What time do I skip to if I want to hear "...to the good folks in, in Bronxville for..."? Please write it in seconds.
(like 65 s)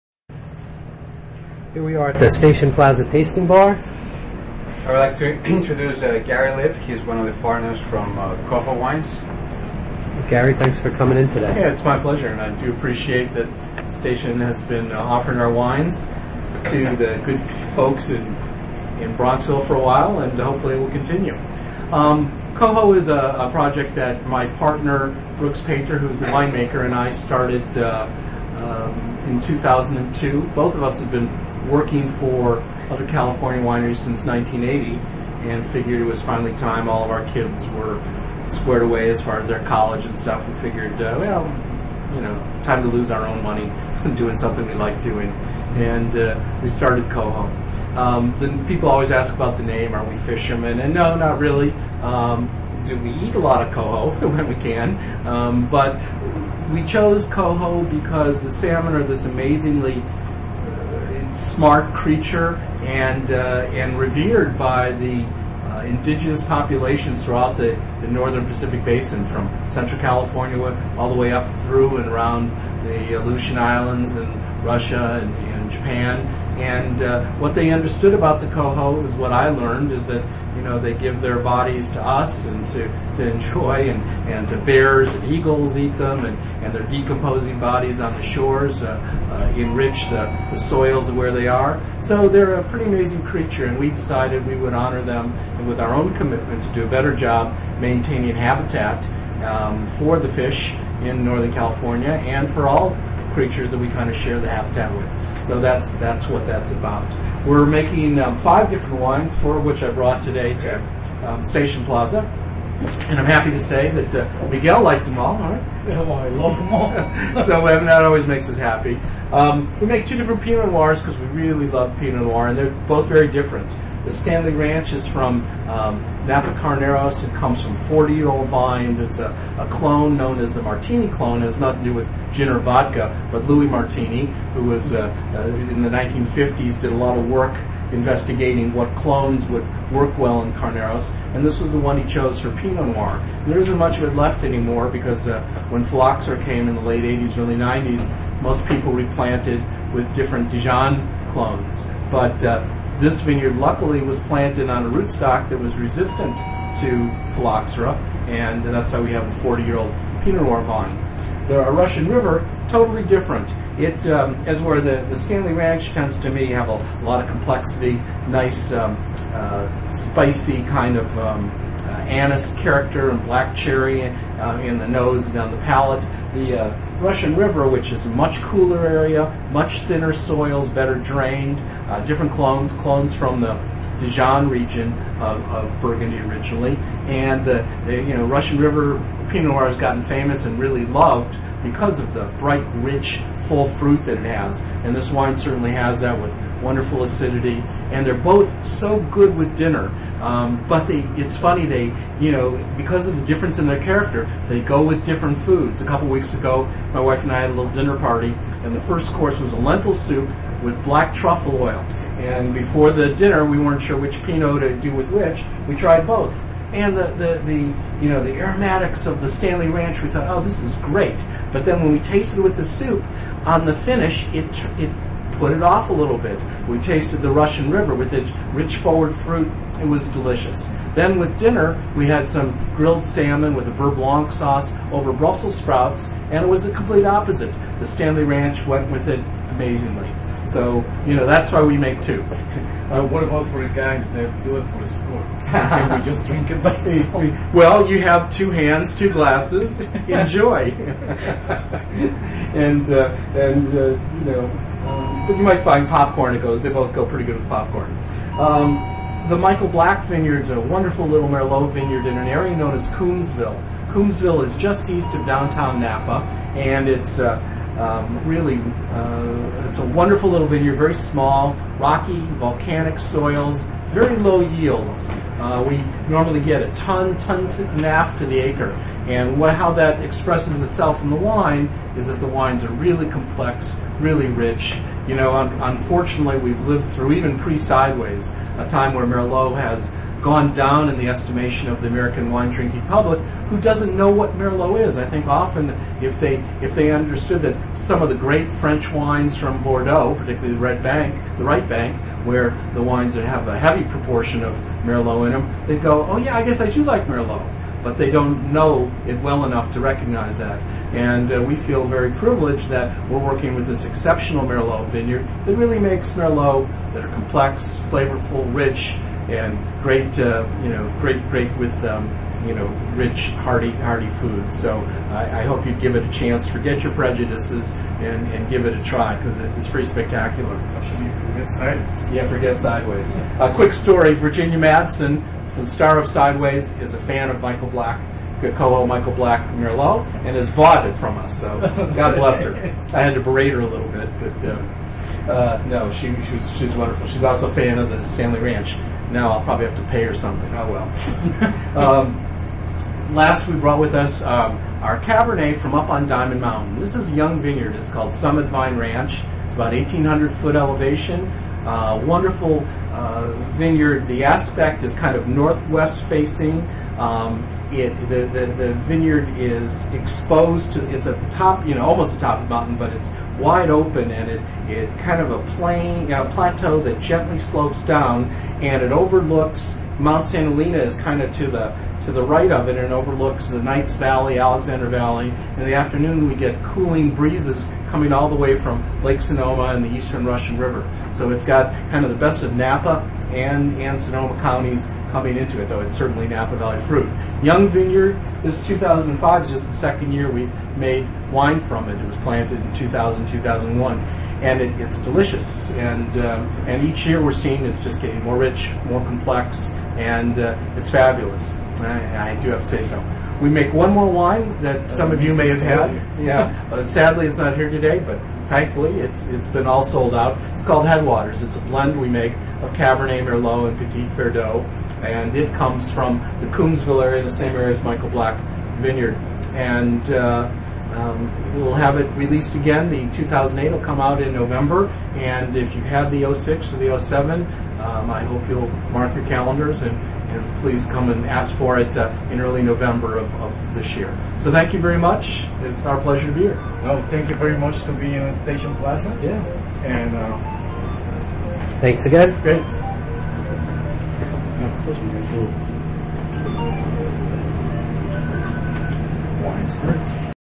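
16 s.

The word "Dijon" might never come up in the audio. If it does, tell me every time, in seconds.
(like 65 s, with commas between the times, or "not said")
150 s, 183 s.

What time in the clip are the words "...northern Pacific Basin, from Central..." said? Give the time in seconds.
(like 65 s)
68 s.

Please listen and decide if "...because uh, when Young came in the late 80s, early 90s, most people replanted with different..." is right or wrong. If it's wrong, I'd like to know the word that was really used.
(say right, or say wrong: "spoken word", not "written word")
wrong: "Phylloxera", not "Young".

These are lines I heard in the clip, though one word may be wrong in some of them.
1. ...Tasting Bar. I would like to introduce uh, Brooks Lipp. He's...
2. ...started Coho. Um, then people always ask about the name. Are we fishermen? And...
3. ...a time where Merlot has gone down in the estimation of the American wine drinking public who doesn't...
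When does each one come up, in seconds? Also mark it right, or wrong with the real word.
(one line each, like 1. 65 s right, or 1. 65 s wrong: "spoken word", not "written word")
1. 3 s wrong: "Gary", not "Brooks"
2. 46 s right
3. 288 s right.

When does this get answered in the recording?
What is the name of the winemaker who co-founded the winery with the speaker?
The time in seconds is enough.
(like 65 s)
25 s.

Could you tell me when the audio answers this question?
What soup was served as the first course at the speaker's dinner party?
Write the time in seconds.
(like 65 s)
209 s.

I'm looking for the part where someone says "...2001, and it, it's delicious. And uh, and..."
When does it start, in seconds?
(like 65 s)
403 s.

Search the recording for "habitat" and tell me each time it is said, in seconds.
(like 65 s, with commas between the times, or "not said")
98 s, 104 s.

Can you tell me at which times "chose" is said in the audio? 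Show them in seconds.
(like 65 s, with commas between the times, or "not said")
56 s, 142 s.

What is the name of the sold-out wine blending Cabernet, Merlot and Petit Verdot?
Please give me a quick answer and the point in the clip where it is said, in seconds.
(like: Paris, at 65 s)
Headwaters, at 420 s.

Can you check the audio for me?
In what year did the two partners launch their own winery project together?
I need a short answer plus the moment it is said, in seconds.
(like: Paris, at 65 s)
2002, at 29 s.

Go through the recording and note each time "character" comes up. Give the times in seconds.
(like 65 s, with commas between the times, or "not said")
172 s, 203 s.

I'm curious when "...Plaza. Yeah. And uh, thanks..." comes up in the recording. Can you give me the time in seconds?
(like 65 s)
448 s.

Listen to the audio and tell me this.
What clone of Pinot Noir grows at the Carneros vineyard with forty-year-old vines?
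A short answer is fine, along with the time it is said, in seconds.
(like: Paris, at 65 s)
Martini clone, at 130 s.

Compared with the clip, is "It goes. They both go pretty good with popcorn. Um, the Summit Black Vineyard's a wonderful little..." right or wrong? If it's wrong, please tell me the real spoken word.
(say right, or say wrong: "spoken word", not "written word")
wrong: "Michael", not "Summit".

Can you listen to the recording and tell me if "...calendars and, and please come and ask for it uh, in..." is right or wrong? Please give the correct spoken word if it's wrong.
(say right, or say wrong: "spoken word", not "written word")
right.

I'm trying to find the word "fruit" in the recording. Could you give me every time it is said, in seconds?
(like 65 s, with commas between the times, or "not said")
193 s, 229 s, 396 s.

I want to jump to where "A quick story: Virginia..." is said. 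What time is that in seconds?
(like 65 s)
333 s.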